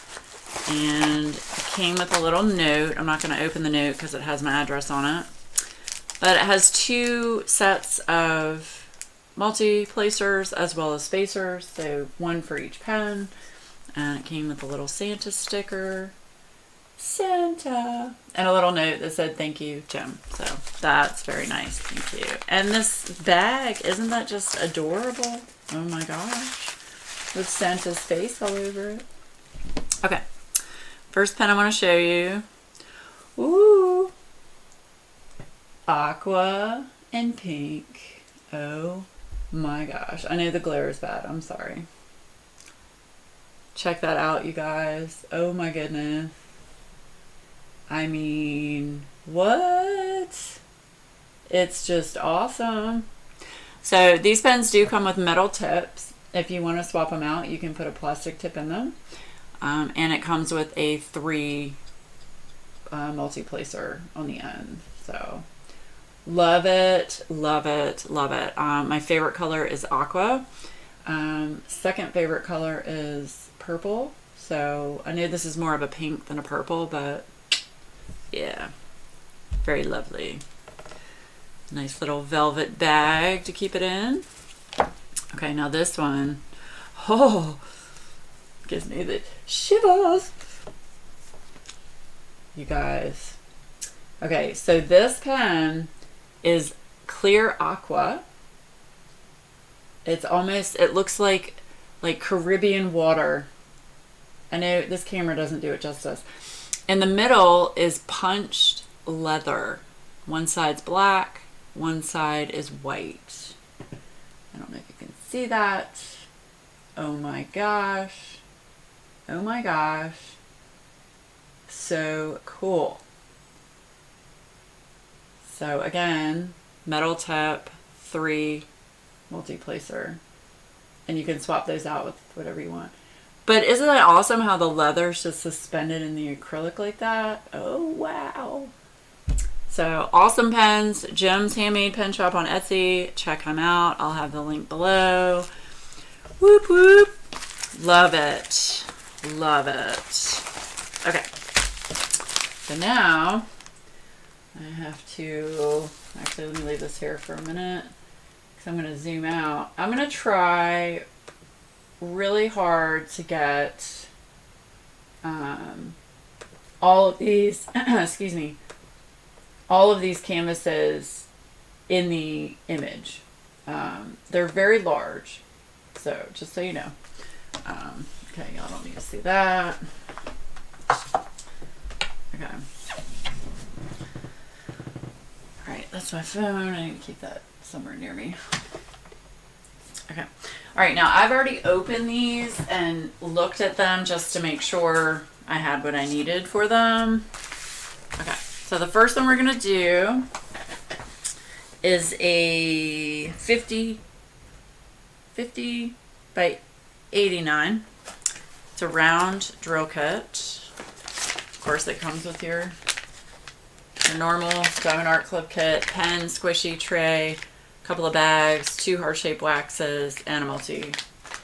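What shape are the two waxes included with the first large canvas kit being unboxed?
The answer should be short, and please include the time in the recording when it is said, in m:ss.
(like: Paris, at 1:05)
Heart-shaped, at 3:38.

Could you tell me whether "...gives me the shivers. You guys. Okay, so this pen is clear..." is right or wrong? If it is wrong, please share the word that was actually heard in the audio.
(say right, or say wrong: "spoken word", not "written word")
right.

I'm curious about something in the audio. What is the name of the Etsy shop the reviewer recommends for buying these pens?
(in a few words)
Jim's Handmade Pen Shop.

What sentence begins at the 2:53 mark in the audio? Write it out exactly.
Um, they're very large, so just so you know.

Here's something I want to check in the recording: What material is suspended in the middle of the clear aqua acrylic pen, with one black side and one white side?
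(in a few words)
Punched leather.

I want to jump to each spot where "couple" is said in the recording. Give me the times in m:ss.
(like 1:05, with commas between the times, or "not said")
3:37.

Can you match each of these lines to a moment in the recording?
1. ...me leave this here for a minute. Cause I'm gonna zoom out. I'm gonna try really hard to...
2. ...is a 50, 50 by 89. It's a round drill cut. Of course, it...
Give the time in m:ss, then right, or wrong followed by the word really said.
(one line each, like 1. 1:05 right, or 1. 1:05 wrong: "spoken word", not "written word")
1. 2:36 right
2. 3:21 right.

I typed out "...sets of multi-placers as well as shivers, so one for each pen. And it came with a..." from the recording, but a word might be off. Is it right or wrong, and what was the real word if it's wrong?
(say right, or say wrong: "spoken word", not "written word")
wrong: "spacers", not "shivers".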